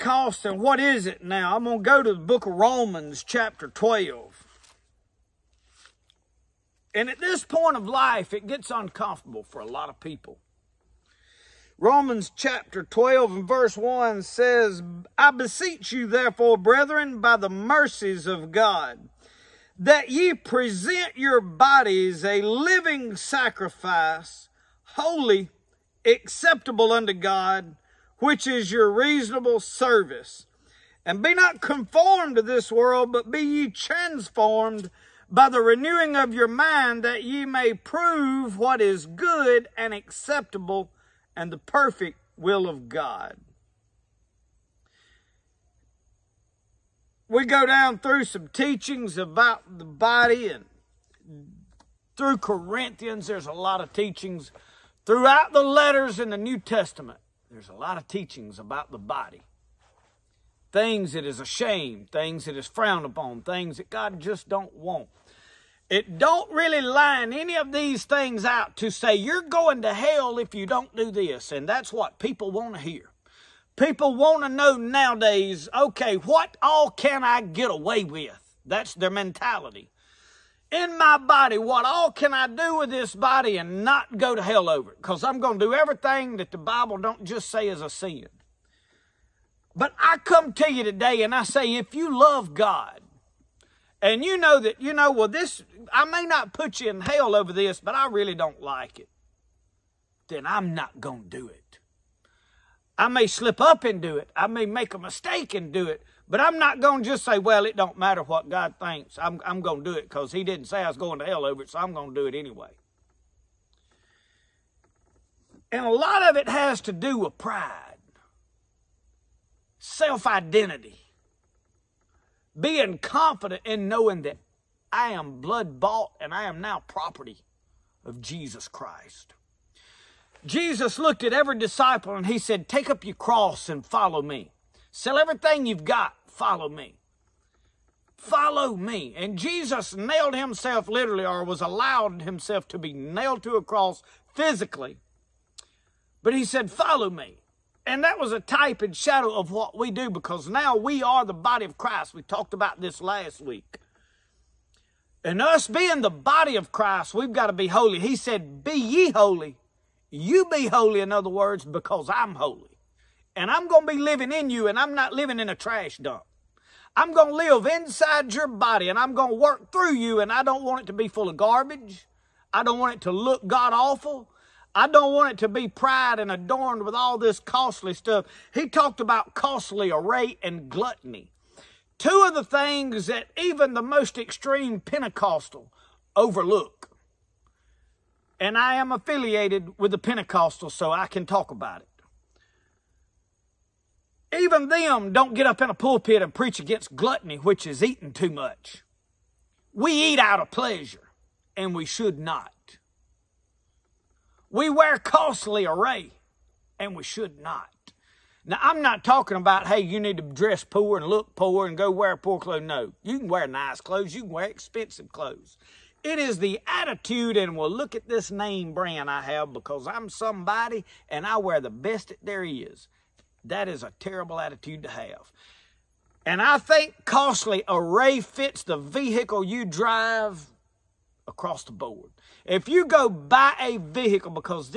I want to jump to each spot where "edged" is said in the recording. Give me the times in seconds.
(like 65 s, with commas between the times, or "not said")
not said.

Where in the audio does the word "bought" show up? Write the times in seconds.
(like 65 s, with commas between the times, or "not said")
125 s.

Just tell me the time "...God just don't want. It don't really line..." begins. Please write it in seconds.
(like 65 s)
63 s.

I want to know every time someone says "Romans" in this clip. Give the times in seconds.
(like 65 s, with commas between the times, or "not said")
2 s, 11 s.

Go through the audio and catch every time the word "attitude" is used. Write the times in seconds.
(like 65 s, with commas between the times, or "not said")
216 s, 224 s.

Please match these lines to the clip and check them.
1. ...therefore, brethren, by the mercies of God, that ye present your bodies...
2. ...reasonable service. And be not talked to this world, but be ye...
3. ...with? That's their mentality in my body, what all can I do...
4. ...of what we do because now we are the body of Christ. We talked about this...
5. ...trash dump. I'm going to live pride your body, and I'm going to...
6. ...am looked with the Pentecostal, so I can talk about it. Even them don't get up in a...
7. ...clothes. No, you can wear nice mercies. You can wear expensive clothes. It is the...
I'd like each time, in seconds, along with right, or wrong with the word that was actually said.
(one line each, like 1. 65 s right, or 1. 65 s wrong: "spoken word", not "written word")
1. 16 s right
2. 28 s wrong: "conformed", not "talked"
3. 78 s right
4. 149 s right
5. 165 s wrong: "inside", not "pride"
6. 188 s wrong: "affiliated", not "looked"
7. 212 s wrong: "clothes", not "mercies".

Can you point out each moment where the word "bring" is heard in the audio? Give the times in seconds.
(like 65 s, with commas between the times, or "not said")
not said.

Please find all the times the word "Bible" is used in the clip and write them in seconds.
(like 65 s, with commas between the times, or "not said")
86 s.